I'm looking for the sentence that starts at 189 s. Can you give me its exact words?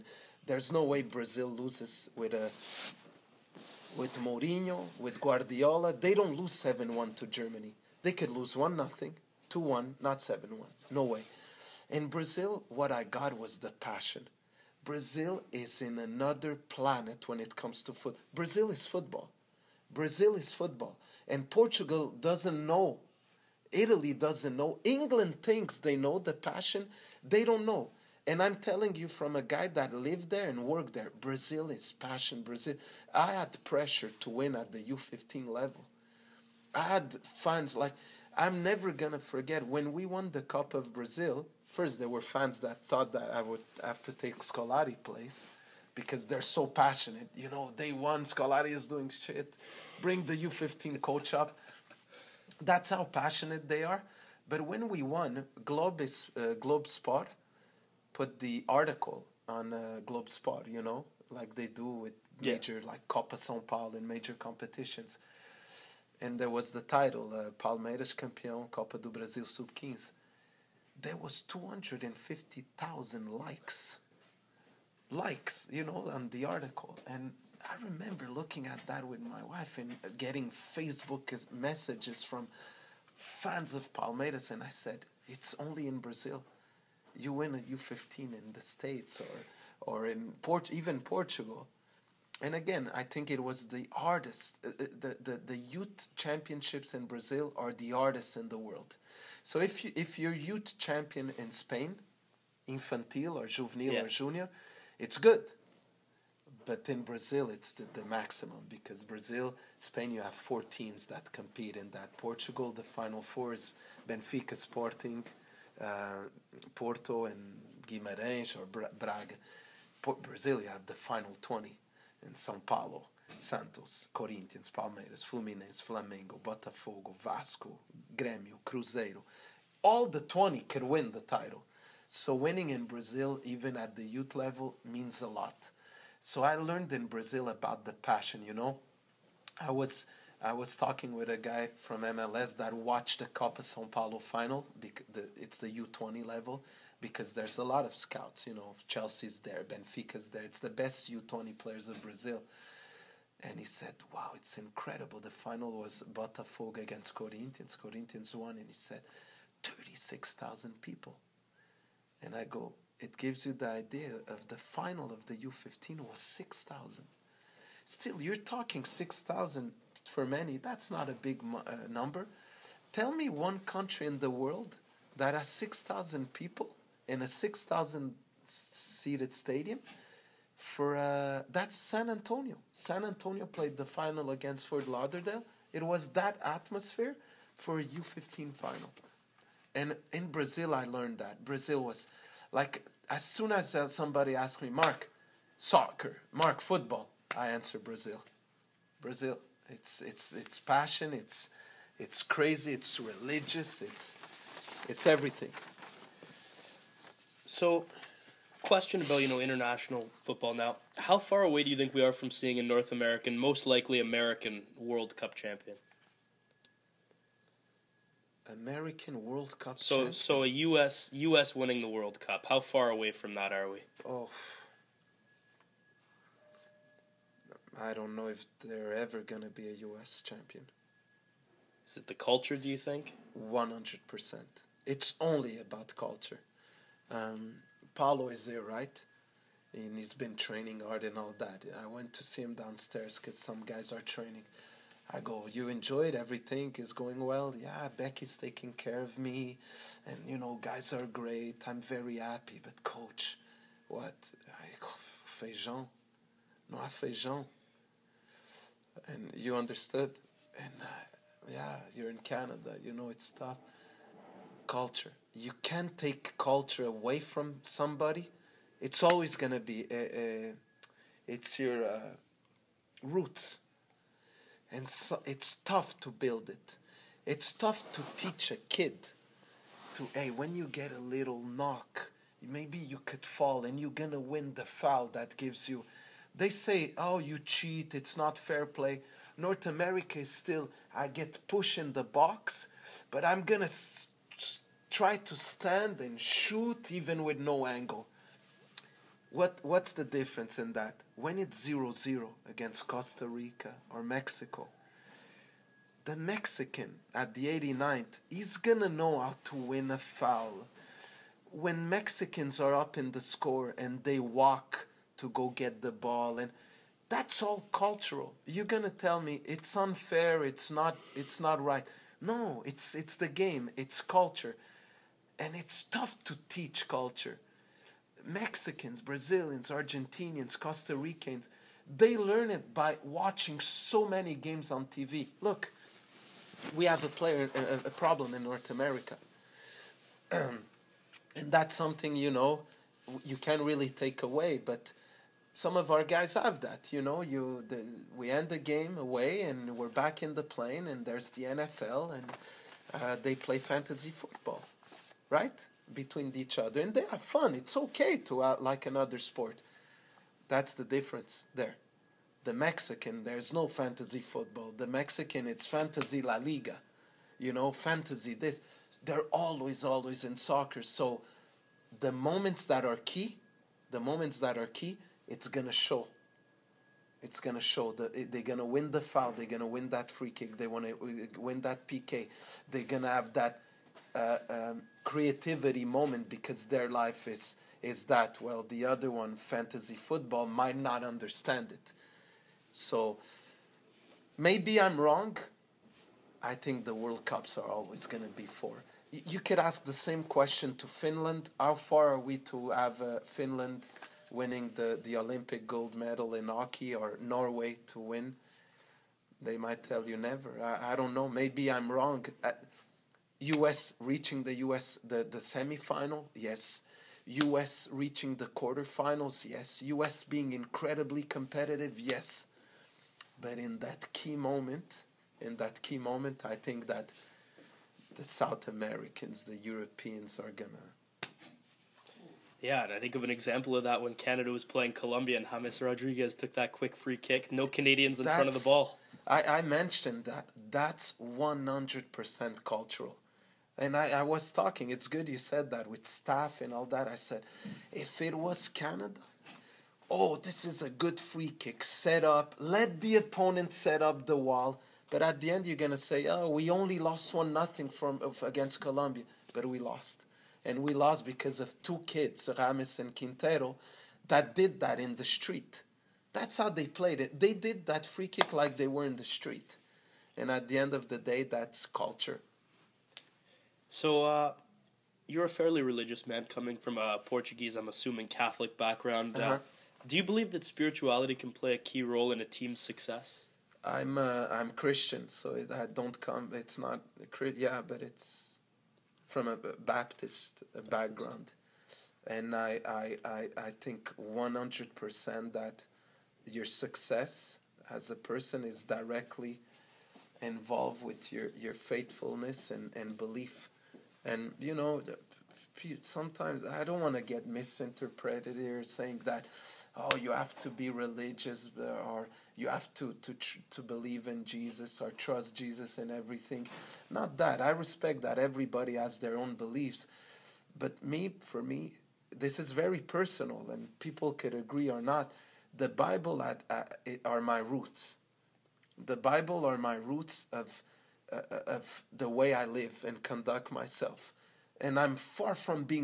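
And in Brazil, I learned that.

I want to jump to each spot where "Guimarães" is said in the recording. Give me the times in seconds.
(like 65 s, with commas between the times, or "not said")
117 s.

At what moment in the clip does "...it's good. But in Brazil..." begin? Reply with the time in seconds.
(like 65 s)
104 s.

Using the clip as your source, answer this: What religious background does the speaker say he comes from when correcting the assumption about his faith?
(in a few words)
Baptist.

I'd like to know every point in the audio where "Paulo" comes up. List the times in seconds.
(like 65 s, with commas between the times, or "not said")
63 s, 122 s, 143 s, 237 s.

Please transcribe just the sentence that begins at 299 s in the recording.
What, what's the difference in that?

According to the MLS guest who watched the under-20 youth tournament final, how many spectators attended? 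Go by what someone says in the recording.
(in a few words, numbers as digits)
36,000.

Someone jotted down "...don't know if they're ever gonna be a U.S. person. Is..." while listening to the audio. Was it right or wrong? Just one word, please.
wrong.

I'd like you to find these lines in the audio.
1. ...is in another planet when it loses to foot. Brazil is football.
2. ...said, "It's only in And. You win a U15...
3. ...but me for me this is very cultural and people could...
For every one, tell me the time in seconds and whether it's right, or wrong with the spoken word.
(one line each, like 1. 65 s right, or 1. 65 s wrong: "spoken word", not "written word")
1. 15 s wrong: "comes", not "loses"
2. 84 s wrong: "Brazil", not "And"
3. 520 s wrong: "personal", not "cultural".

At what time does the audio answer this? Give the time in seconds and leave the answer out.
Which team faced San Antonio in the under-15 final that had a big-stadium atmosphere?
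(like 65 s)
184 s.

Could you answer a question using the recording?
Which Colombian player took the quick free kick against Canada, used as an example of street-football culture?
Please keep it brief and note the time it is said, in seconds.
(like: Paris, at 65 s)
James Rodriguez, at 435 s.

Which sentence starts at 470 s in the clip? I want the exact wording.
And at the end of the day, that's culture.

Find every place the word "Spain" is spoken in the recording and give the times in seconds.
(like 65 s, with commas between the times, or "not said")
101 s, 109 s.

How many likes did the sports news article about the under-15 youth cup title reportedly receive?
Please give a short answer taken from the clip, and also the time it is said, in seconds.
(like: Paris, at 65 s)
250,000, at 71 s.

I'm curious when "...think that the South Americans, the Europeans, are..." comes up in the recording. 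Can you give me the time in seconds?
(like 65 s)
426 s.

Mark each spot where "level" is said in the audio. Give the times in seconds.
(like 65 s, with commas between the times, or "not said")
35 s, 134 s, 146 s.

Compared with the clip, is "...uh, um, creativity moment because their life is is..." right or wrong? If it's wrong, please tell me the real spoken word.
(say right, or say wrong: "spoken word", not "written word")
right.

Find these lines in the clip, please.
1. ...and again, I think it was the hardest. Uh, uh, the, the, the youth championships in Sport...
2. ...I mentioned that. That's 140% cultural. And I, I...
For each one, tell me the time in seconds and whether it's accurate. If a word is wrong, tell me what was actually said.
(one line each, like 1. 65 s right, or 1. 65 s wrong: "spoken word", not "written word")
1. 92 s wrong: "Brazil", not "Sport"
2. 439 s wrong: "100", not "140".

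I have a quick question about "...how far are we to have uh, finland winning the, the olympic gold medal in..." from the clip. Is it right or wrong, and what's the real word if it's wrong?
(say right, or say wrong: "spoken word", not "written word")
right.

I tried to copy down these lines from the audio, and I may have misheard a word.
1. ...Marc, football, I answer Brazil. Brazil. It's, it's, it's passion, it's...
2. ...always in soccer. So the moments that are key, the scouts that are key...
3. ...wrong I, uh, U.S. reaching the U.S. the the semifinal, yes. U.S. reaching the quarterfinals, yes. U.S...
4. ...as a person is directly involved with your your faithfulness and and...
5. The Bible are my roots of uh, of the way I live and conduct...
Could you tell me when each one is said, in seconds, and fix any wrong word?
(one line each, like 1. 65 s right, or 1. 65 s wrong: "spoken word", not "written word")
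1. 196 s right
2. 369 s wrong: "moments", not "scouts"
3. 411 s right
4. 497 s right
5. 529 s right.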